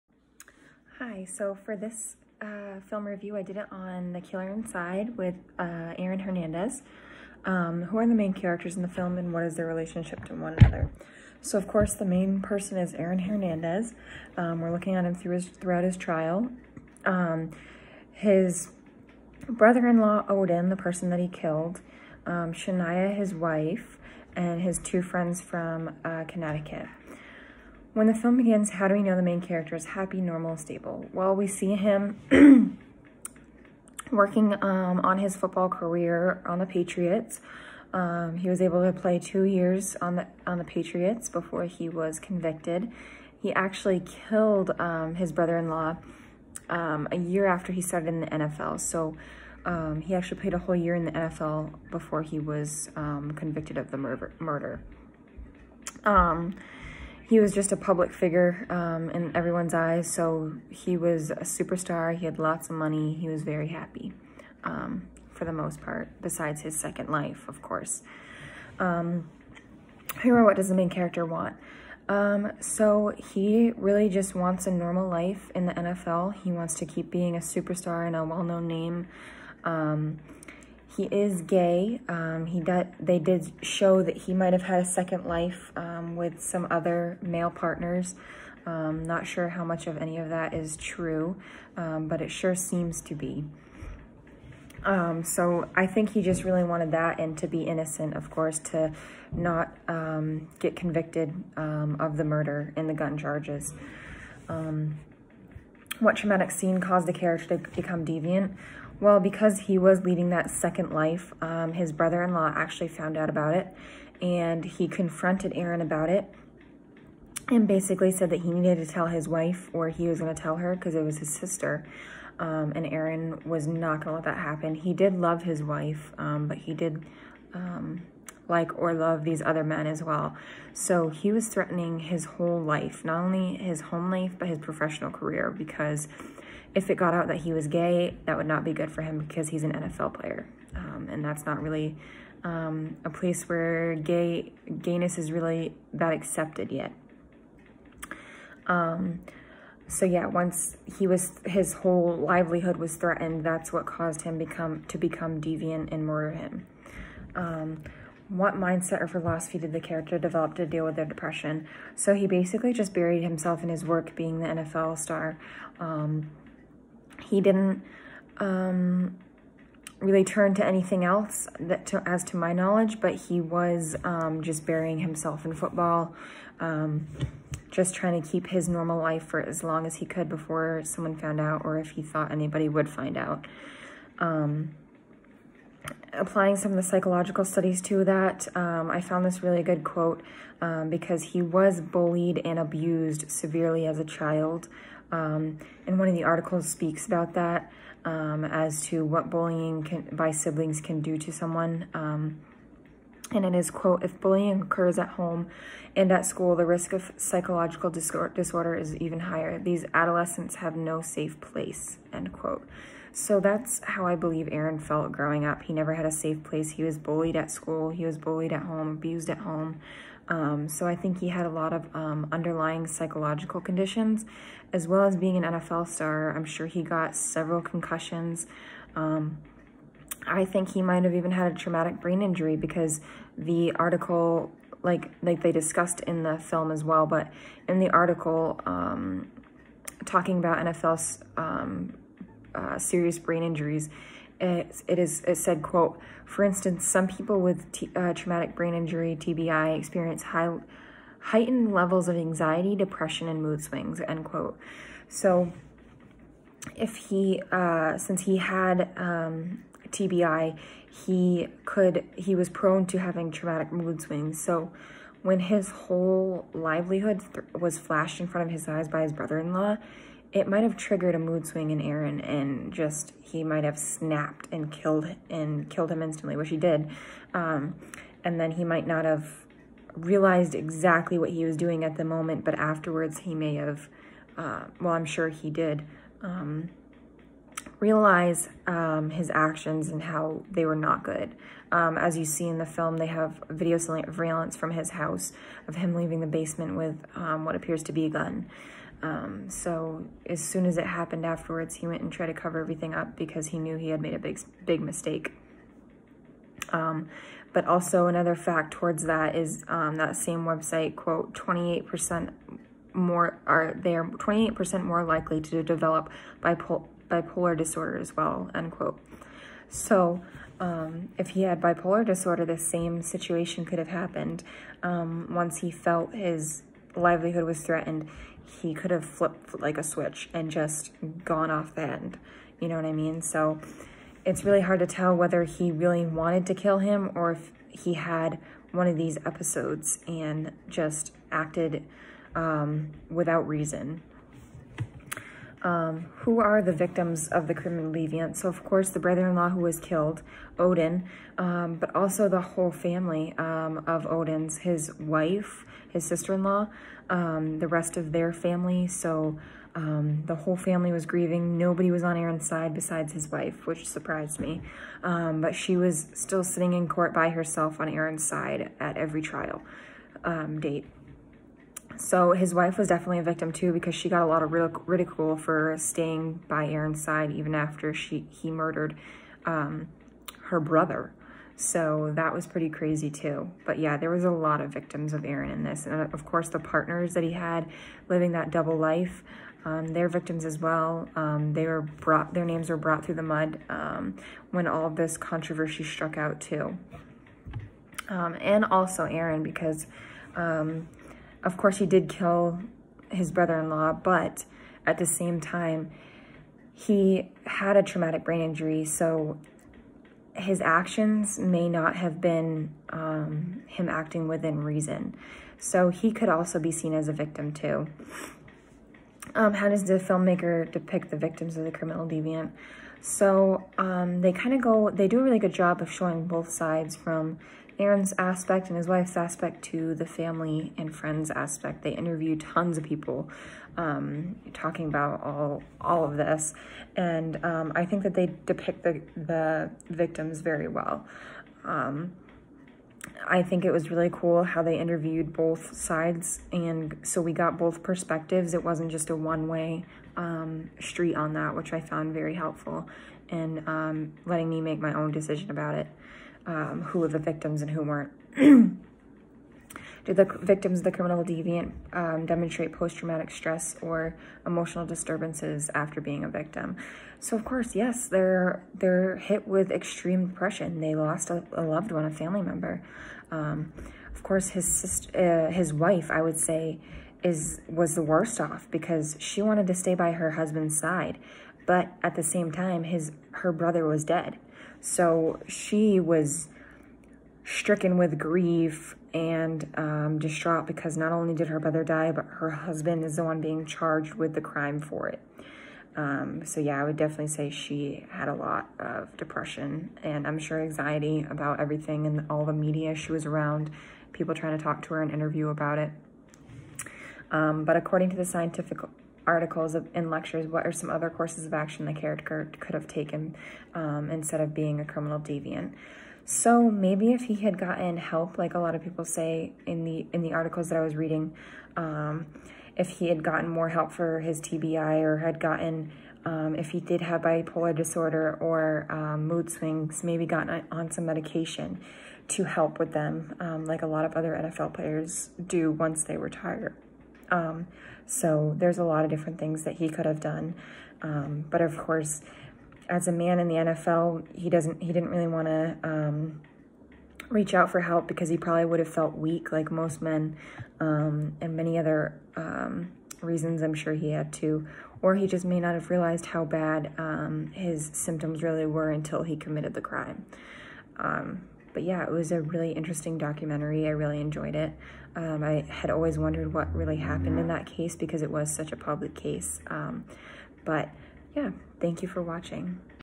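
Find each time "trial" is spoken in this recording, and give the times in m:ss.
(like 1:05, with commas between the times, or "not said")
0:15, 6:09.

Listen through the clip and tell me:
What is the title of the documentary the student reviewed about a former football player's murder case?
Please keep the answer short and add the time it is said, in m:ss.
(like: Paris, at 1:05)
The Killer Inside, at 0:04.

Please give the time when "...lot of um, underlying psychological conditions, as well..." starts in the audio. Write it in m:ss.
3:41.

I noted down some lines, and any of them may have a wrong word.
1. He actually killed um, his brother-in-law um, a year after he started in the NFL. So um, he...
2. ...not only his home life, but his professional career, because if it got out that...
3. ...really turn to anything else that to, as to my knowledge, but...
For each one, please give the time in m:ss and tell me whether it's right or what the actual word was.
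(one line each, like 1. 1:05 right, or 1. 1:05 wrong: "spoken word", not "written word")
1. 0:43 right
2. 2:13 right
3. 2:49 right.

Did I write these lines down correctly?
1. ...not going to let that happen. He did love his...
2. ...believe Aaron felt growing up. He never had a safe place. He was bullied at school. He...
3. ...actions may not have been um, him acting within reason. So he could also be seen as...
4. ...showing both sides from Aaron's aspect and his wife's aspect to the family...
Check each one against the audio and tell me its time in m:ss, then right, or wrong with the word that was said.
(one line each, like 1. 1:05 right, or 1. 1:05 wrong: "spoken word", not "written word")
1. 2:03 right
2. 3:34 right
3. 6:50 right
4. 7:05 right.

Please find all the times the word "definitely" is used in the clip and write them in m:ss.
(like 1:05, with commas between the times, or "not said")
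6:12, 8:16.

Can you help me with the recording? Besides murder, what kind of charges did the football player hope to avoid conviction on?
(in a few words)
Gun charges.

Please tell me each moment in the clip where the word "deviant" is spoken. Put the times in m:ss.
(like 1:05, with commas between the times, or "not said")
1:48, 2:35, 5:47, 7:02, 7:41, 8:35.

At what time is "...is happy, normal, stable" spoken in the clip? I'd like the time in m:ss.
0:29.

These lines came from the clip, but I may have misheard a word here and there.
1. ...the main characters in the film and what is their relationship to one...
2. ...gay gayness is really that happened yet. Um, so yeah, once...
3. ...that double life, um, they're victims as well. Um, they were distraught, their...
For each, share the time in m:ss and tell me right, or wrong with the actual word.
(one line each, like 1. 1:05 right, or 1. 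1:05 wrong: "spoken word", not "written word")
1. 0:08 right
2. 2:23 wrong: "accepted", not "happened"
3. 6:28 wrong: "brought", not "distraught".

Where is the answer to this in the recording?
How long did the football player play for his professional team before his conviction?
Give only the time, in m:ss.
0:39.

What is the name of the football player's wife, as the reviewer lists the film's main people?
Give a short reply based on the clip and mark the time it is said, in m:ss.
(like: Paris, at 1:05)
Shania, at 0:22.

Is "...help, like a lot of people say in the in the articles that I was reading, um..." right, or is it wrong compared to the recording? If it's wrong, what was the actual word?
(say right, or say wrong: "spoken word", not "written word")
right.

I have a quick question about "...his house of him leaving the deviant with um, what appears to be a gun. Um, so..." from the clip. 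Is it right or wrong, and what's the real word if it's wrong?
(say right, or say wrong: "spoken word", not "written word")
wrong: "basement", not "deviant".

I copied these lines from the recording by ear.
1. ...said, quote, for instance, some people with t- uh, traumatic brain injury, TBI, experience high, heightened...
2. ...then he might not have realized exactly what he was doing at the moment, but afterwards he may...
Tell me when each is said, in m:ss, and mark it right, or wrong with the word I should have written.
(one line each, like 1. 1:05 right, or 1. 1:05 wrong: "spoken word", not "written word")
1. 4:05 right
2. 4:38 right.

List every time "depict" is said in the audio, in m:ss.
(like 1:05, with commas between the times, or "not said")
7:00, 7:18.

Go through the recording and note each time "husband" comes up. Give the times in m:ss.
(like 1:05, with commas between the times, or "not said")
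8:00, 8:12.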